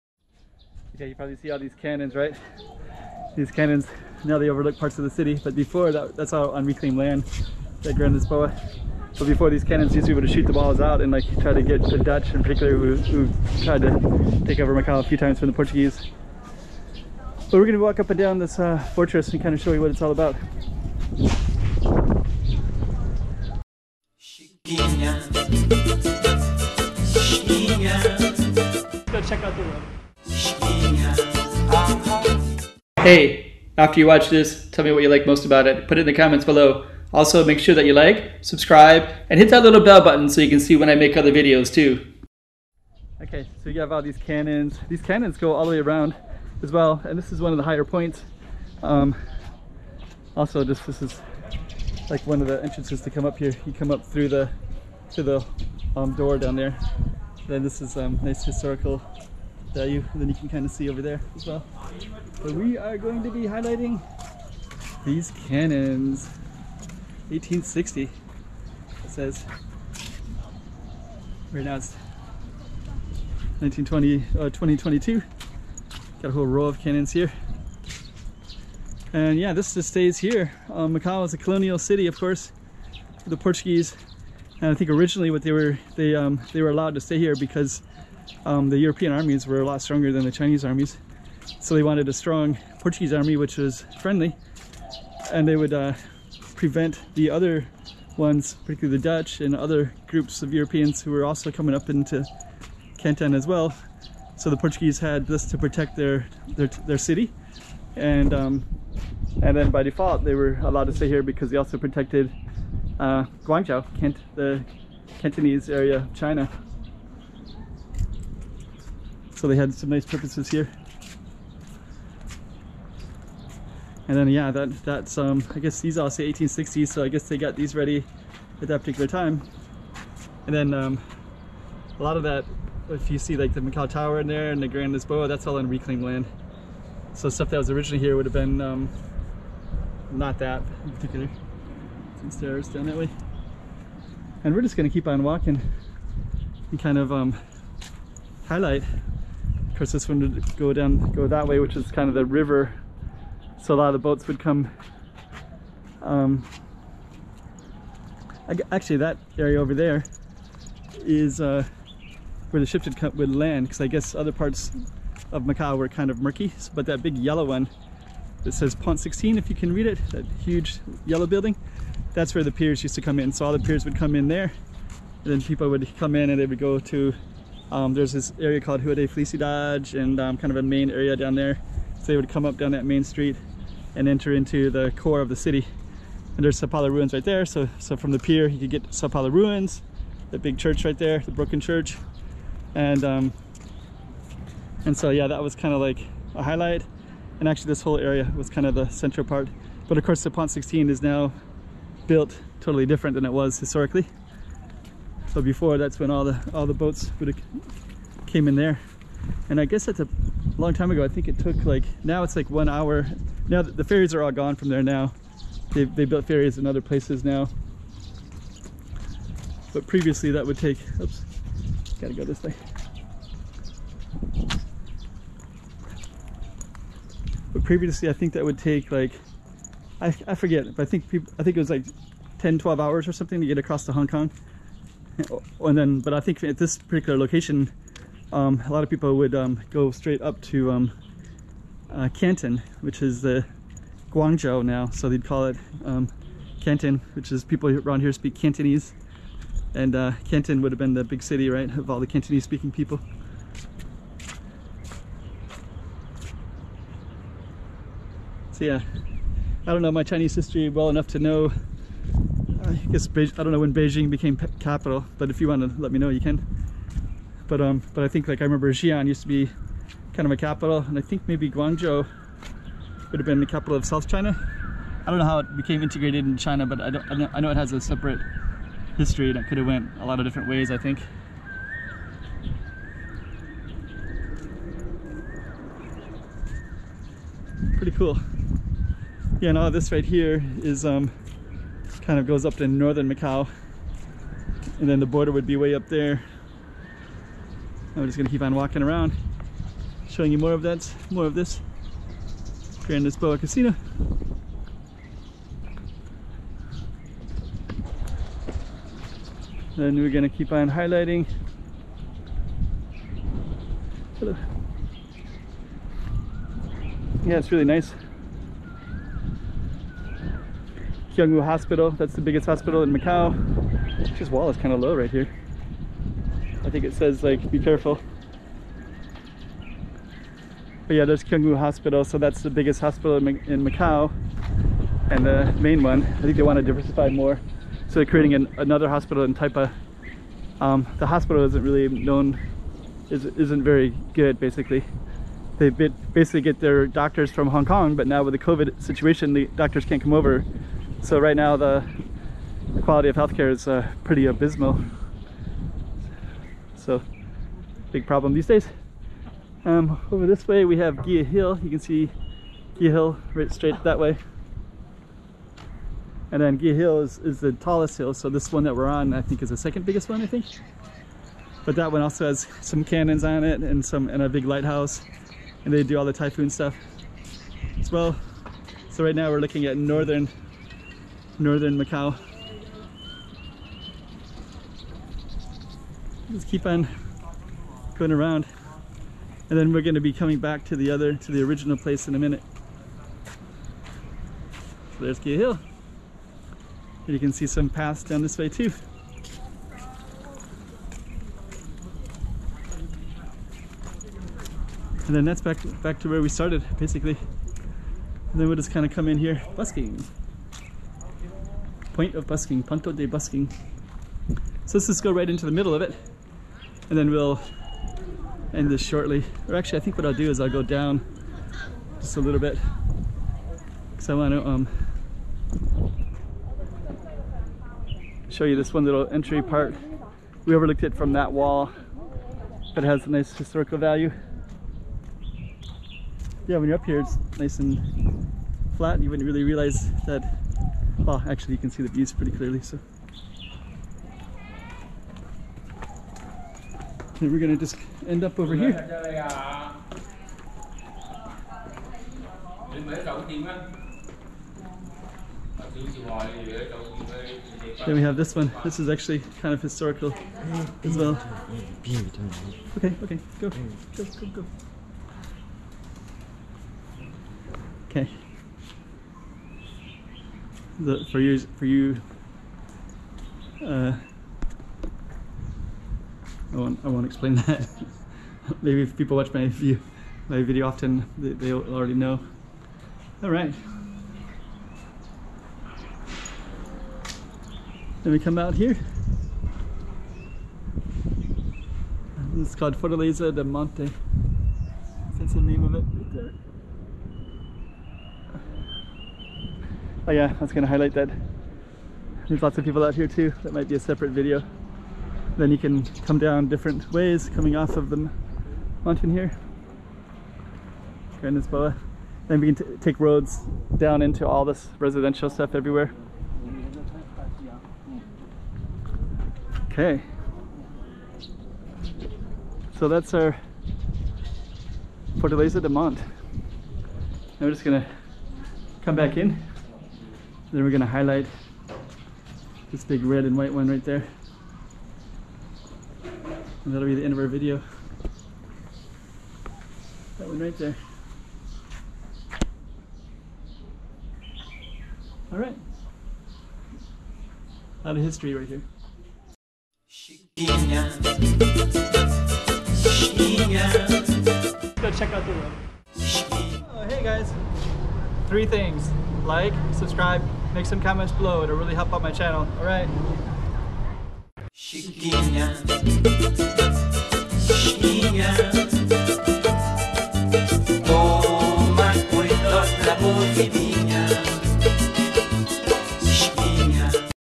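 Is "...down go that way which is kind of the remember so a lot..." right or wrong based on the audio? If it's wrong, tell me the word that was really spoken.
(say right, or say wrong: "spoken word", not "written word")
wrong: "river", not "remember".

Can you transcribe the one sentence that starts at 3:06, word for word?
And there's Sao ruins right there.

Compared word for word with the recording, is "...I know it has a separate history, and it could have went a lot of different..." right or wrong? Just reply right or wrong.
right.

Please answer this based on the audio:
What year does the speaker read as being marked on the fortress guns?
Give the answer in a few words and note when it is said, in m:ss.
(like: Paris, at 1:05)
1860, at 1:07.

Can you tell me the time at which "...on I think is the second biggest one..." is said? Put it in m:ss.
6:08.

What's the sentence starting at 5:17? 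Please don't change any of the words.
yeah it's really nice Kiang Wu Hospital.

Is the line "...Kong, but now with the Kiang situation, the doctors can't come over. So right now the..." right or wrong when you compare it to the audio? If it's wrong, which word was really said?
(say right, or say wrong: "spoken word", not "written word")
wrong: "COVID", not "Kiang".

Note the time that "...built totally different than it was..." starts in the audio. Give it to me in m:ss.
3:22.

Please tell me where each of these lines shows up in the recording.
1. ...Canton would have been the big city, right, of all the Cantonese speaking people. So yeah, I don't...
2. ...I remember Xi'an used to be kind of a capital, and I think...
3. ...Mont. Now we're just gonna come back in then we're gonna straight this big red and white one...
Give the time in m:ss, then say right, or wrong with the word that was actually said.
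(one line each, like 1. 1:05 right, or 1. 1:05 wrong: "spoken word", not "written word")
1. 4:10 right
2. 4:28 right
3. 8:45 wrong: "highlight", not "straight".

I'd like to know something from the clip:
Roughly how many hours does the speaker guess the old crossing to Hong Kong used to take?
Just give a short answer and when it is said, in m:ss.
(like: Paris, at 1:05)
10 12 hours, at 3:52.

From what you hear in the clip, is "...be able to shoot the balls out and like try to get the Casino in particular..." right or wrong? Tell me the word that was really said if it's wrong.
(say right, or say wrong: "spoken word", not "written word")
wrong: "Dutch", not "Casino".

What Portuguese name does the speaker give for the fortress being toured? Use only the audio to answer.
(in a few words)
Fortaleza de Monte.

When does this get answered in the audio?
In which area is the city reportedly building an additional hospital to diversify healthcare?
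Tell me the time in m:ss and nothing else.
5:39.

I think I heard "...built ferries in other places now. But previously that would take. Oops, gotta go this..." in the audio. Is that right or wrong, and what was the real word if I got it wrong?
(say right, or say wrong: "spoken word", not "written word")
right.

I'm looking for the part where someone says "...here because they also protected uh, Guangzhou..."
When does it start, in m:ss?
1:51.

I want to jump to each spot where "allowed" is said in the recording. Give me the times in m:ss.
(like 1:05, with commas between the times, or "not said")
1:26, 1:50.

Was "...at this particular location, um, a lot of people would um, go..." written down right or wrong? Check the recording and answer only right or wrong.
right.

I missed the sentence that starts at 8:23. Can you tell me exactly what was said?
That might be a separate video.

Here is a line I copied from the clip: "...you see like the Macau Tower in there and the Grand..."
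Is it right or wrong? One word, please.
right.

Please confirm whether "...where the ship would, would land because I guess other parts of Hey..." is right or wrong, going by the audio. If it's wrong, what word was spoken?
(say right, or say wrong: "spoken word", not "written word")
wrong: "Macau", not "Hey".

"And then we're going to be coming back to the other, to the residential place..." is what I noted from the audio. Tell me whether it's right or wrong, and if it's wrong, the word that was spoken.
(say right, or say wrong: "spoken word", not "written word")
wrong: "original", not "residential".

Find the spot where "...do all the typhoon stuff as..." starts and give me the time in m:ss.
6:15.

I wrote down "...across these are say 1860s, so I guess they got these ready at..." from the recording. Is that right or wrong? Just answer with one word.
wrong.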